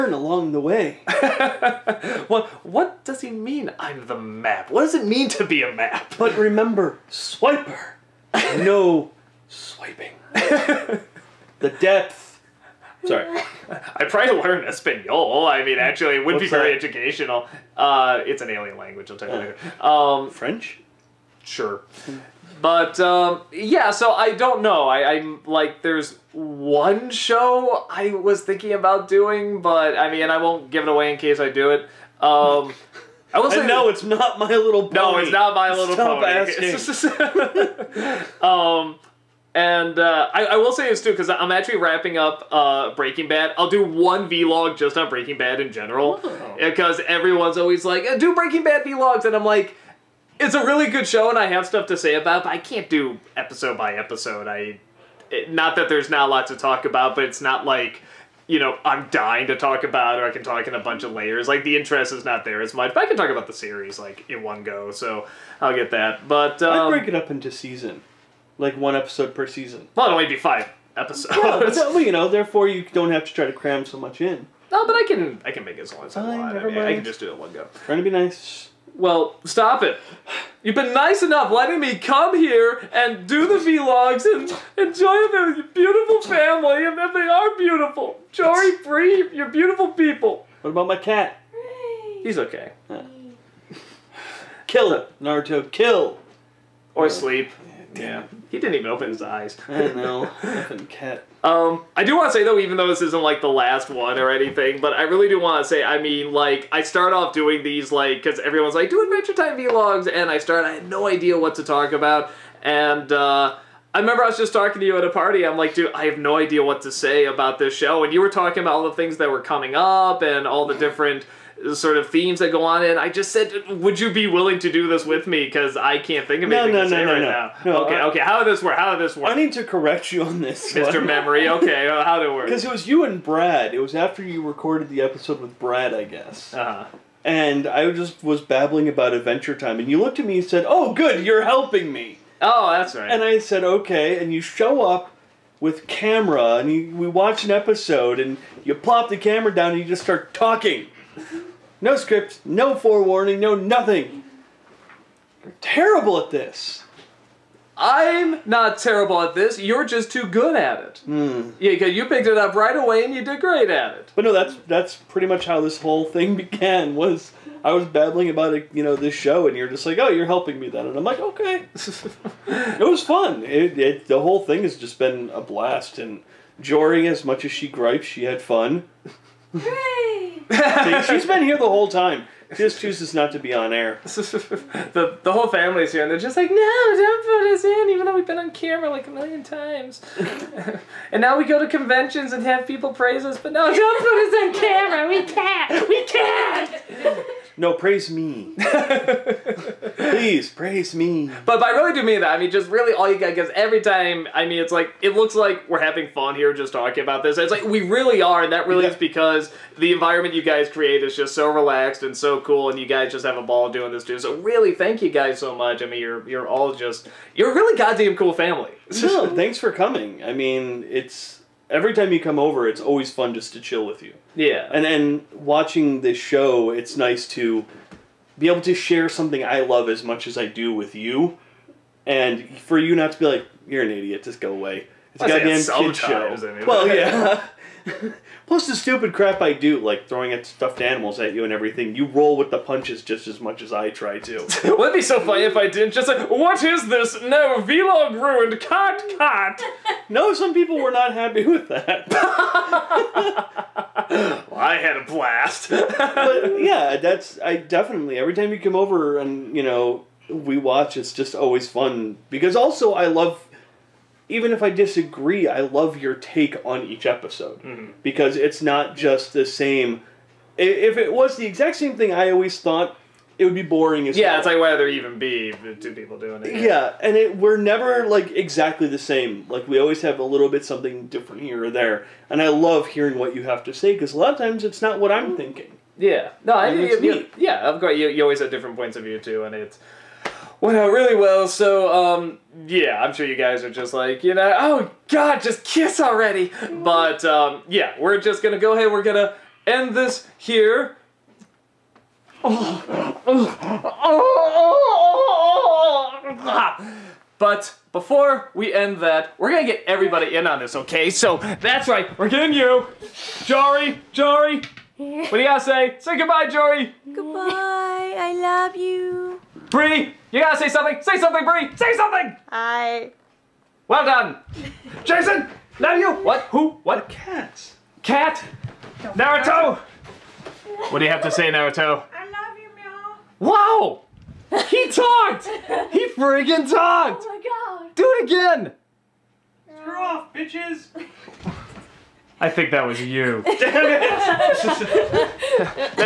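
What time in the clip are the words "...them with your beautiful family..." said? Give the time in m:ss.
1:25.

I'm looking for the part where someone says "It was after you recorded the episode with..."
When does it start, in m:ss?
2:13.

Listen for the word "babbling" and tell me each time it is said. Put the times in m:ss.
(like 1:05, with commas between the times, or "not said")
2:18, 2:47.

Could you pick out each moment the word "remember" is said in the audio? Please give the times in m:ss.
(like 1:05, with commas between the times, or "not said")
0:06, 1:53.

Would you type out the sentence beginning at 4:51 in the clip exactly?
So, um, yeah, I'm sure you guys are just like, you know, oh God, just kiss already.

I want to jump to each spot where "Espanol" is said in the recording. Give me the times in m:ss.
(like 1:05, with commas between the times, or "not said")
0:14.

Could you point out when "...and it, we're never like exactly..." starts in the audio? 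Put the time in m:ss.
4:37.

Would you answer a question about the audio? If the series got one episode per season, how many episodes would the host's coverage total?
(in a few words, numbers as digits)
5.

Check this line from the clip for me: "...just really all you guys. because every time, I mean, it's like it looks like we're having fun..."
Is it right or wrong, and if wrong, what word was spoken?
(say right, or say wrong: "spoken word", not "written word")
right.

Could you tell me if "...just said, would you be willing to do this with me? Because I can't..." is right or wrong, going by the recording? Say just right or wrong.
right.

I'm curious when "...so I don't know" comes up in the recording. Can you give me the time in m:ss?
0:23.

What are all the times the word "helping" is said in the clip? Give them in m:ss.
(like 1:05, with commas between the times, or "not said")
2:21, 2:50.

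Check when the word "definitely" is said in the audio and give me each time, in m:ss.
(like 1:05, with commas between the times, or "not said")
4:17.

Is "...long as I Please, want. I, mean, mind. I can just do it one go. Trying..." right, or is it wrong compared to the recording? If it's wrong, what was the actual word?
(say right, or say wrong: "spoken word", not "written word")
wrong: "Fine", not "Please".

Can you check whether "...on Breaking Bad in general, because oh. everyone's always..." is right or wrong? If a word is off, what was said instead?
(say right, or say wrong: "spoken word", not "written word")
right.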